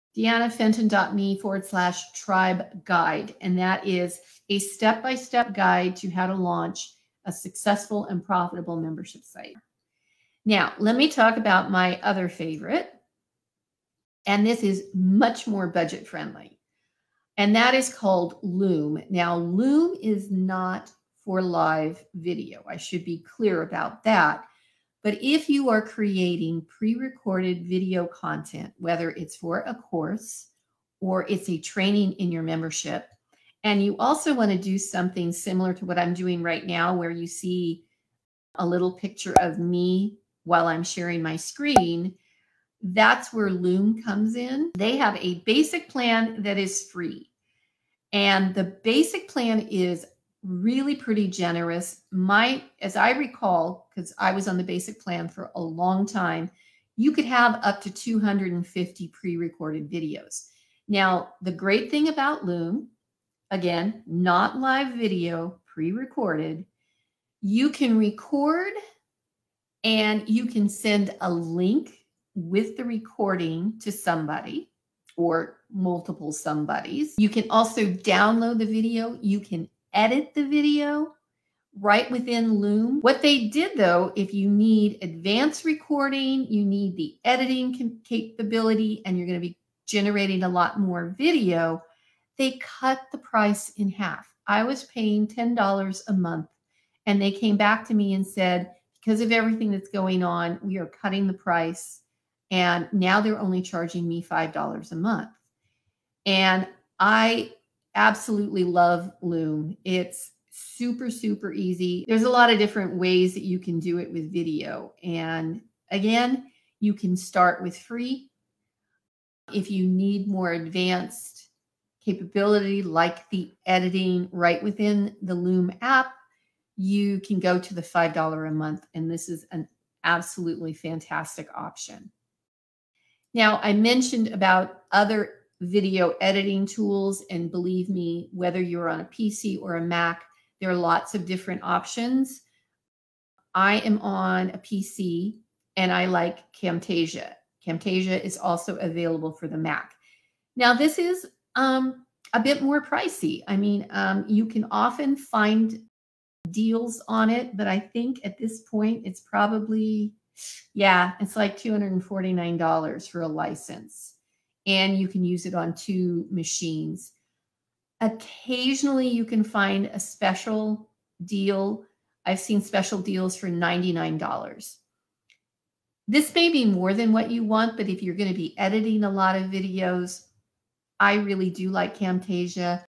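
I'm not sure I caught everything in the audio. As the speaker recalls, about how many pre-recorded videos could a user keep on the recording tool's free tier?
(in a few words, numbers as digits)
250.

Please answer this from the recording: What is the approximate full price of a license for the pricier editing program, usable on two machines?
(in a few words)
$249.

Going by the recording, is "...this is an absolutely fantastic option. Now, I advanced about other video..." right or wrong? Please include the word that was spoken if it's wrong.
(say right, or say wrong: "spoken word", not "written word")
wrong: "mentioned", not "advanced".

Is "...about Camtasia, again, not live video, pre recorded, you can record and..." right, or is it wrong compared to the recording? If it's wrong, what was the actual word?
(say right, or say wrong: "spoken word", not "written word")
wrong: "Loom", not "Camtasia".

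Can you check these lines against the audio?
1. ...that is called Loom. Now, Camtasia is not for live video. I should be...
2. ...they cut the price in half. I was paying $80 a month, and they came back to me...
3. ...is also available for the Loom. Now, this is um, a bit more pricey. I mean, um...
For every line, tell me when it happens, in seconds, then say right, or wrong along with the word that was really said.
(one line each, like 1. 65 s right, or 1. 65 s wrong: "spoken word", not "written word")
1. 17 s wrong: "Loom", not "Camtasia"
2. 92 s wrong: "10", not "80"
3. 148 s wrong: "Mac", not "Loom".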